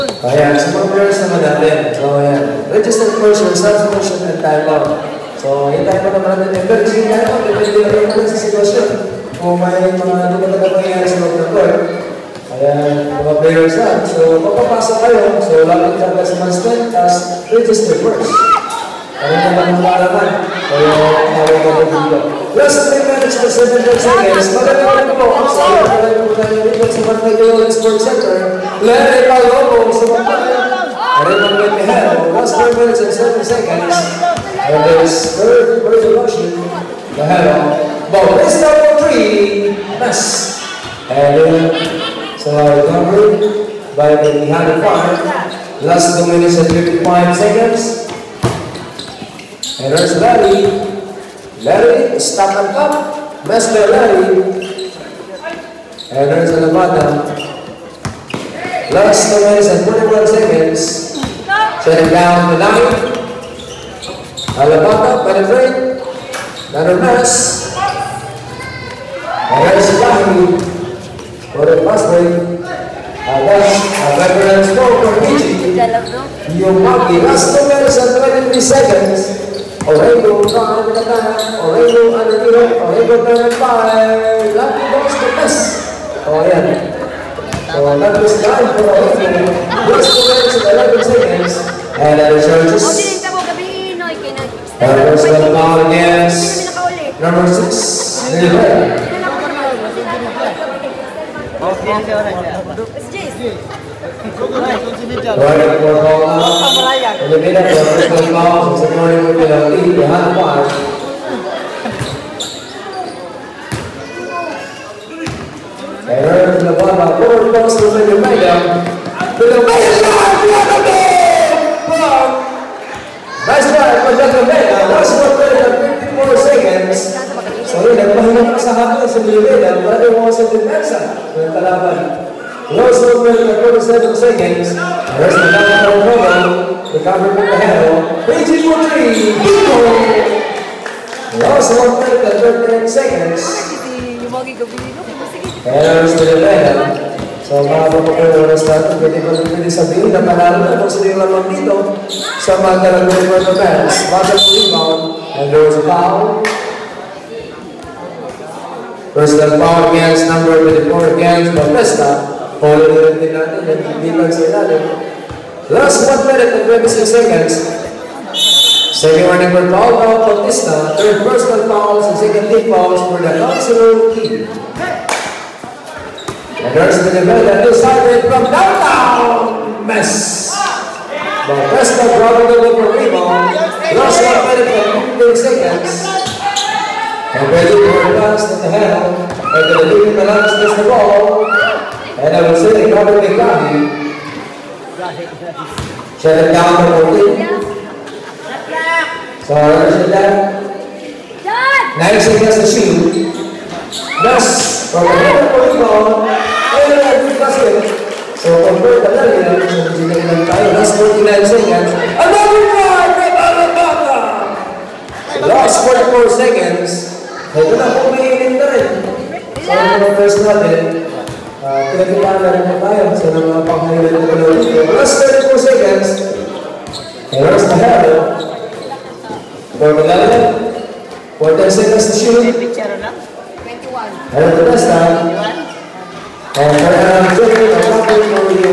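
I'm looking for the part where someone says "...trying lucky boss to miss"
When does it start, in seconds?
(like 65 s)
83 s.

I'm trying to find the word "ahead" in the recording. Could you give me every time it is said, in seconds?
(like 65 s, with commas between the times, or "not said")
not said.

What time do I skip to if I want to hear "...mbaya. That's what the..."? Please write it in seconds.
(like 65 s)
124 s.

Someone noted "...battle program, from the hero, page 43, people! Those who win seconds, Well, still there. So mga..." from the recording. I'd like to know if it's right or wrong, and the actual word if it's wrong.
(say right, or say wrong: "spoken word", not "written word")
right.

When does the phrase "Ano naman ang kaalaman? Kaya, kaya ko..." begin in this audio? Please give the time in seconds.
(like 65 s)
19 s.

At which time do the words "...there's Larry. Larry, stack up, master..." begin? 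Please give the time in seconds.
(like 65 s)
49 s.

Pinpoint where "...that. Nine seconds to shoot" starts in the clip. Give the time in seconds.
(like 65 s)
200 s.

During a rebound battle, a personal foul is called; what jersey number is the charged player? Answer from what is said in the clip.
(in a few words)
24.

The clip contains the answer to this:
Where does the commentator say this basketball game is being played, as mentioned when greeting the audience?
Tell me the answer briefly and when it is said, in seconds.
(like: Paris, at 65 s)
Barangay Sports Center, at 27 s.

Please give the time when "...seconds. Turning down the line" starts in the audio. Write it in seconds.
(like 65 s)
60 s.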